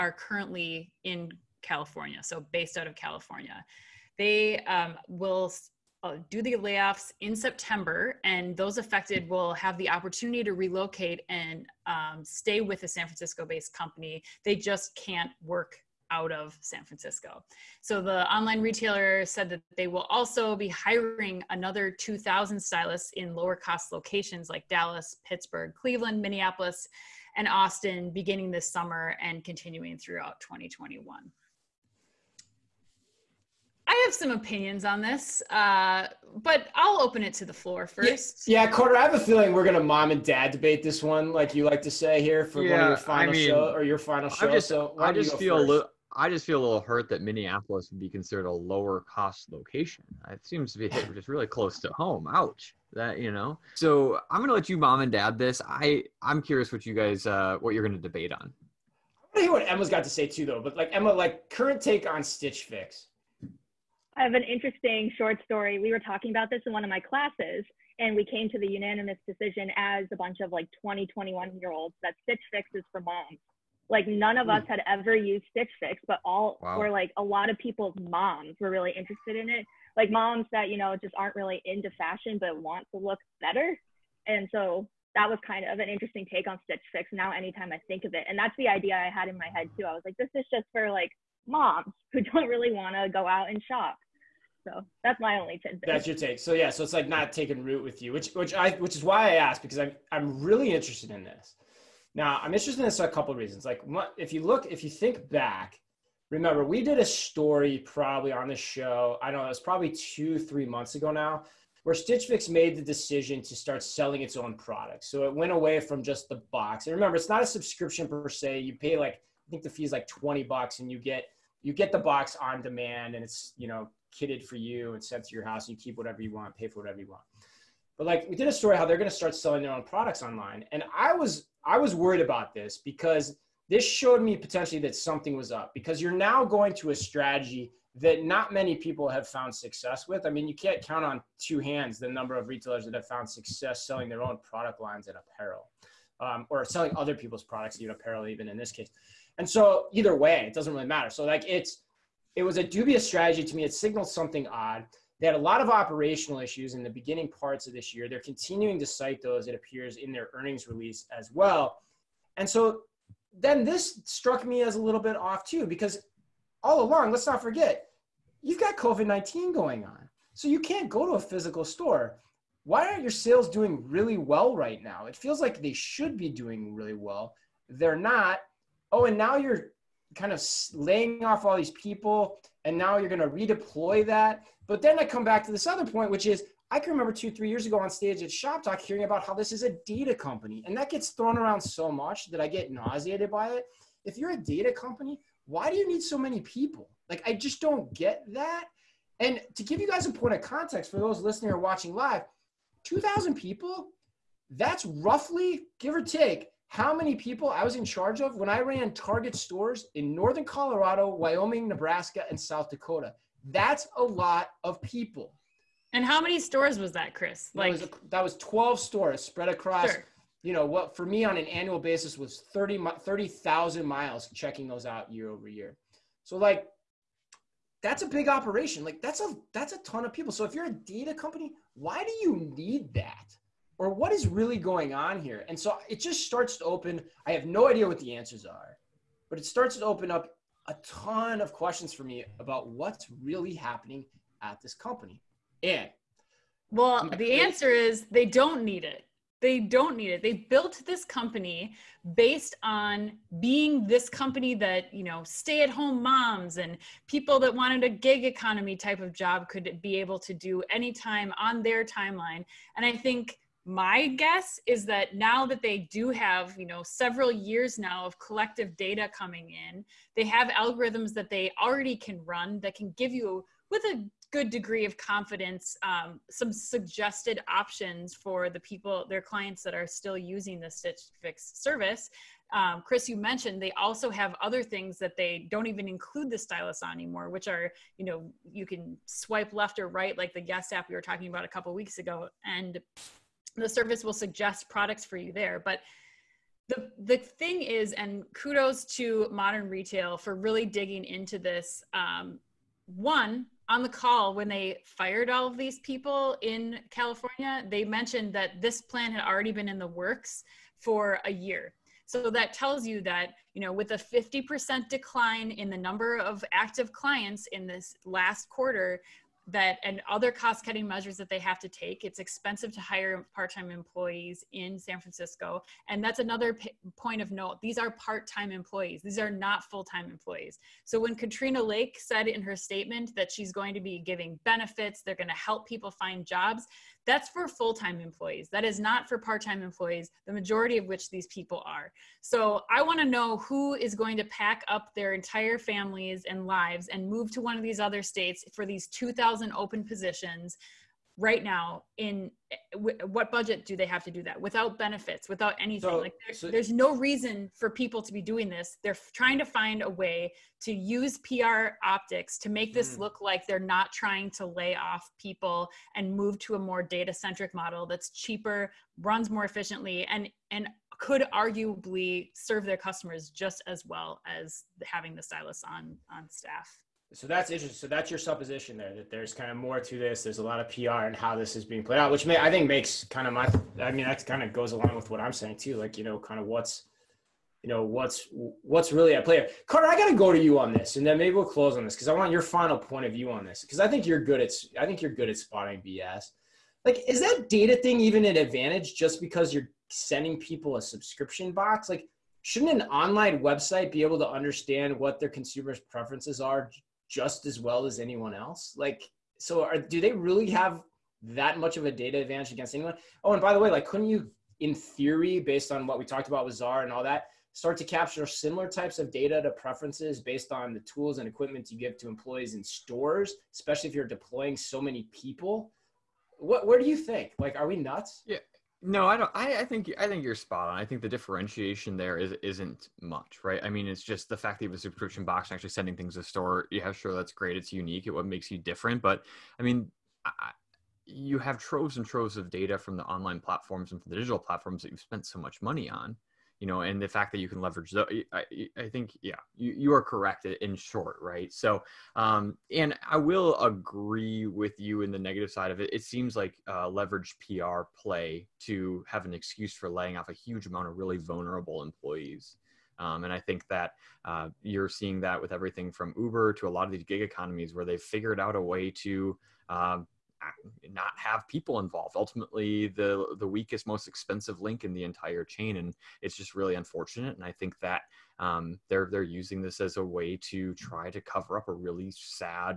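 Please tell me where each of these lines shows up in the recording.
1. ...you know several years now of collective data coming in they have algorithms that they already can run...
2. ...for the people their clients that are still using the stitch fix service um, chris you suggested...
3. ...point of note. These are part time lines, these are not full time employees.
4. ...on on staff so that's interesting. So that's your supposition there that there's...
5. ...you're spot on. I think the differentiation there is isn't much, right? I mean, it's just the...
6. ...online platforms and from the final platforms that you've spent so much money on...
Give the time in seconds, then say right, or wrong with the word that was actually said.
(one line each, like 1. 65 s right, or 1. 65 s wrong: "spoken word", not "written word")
1. 266 s right
2. 278 s wrong: "mentioned", not "suggested"
3. 326 s wrong: "employees", not "lines"
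4. 375 s right
5. 430 s right
6. 443 s wrong: "digital", not "final".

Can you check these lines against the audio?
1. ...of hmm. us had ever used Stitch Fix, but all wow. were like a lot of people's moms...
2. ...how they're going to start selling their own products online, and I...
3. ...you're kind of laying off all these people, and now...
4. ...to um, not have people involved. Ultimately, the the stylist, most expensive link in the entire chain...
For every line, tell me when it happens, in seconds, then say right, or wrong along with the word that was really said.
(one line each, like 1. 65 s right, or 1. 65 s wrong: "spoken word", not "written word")
1. 74 s right
2. 128 s right
3. 179 s right
4. 469 s wrong: "weakest", not "stylist".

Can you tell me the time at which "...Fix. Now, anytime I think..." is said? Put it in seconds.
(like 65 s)
86 s.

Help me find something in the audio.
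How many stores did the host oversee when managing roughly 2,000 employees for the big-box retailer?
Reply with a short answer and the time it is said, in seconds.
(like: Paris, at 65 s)
12, at 218 s.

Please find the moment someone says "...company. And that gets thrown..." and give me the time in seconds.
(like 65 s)
190 s.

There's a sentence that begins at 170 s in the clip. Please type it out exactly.
So you can't go to a physical store.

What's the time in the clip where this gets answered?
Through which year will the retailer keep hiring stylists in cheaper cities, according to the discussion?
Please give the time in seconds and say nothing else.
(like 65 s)
30 s.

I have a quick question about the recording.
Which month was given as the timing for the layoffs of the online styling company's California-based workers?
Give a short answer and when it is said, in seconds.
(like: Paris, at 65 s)
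September, at 7 s.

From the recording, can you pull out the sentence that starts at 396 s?
Like, is that data thing even an advantage just because you're sending people a subscription box?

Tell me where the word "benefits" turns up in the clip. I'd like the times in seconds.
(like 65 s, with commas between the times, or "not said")
334 s, 354 s.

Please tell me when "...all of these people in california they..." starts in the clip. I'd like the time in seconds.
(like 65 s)
305 s.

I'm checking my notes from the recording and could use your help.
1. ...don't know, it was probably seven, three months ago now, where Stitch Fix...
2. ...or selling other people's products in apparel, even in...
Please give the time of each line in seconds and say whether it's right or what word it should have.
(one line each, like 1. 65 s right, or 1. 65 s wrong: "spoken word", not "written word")
1. 109 s wrong: "two", not "seven"
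2. 146 s right.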